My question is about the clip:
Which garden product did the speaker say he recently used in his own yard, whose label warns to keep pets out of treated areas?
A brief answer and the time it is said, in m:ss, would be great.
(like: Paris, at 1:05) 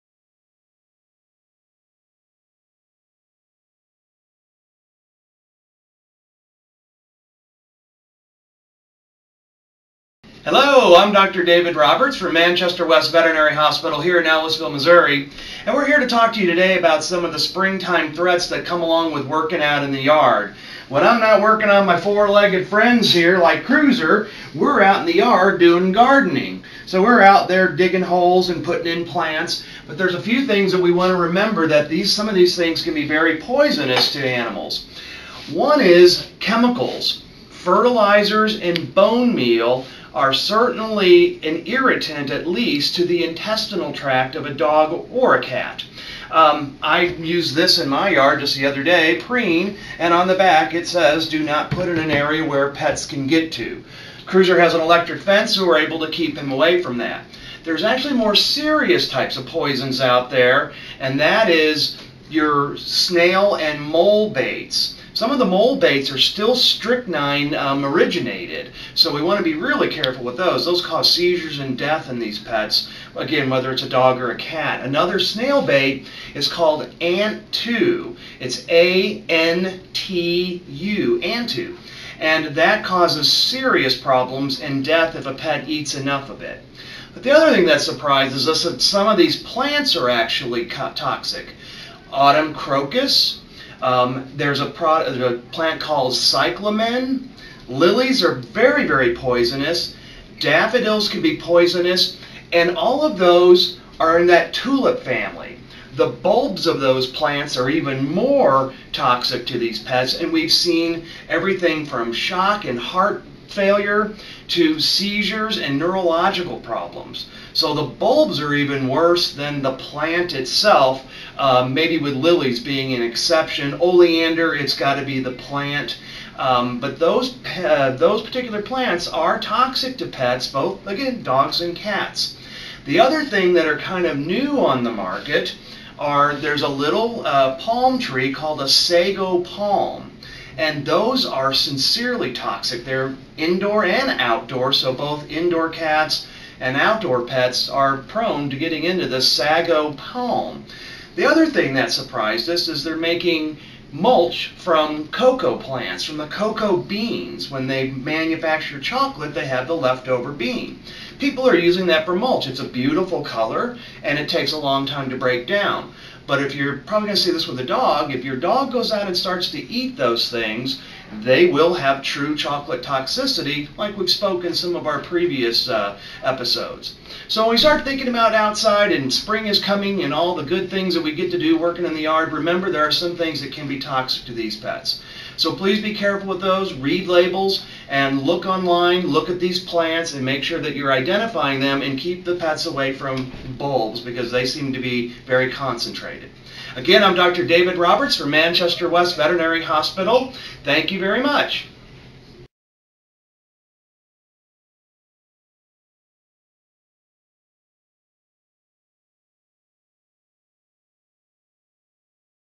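Preen, at 0:49.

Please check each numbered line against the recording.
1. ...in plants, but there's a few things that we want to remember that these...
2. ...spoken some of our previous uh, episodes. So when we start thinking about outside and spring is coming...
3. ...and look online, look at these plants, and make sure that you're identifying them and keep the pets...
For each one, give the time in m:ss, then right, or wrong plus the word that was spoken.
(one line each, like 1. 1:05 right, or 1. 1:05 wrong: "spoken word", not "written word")
1. 0:28 right
2. 2:54 right
3. 3:07 right.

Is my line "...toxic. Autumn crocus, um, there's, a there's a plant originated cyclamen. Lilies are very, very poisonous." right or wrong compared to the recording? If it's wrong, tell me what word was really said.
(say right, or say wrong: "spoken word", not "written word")
wrong: "called", not "originated".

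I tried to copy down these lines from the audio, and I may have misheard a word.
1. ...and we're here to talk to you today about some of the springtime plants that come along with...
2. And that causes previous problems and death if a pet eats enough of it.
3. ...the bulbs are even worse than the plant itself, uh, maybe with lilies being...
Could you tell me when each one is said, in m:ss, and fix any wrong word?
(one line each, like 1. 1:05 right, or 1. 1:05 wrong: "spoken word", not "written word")
1. 0:15 wrong: "threats", not "plants"
2. 1:22 wrong: "serious", not "previous"
3. 1:57 right.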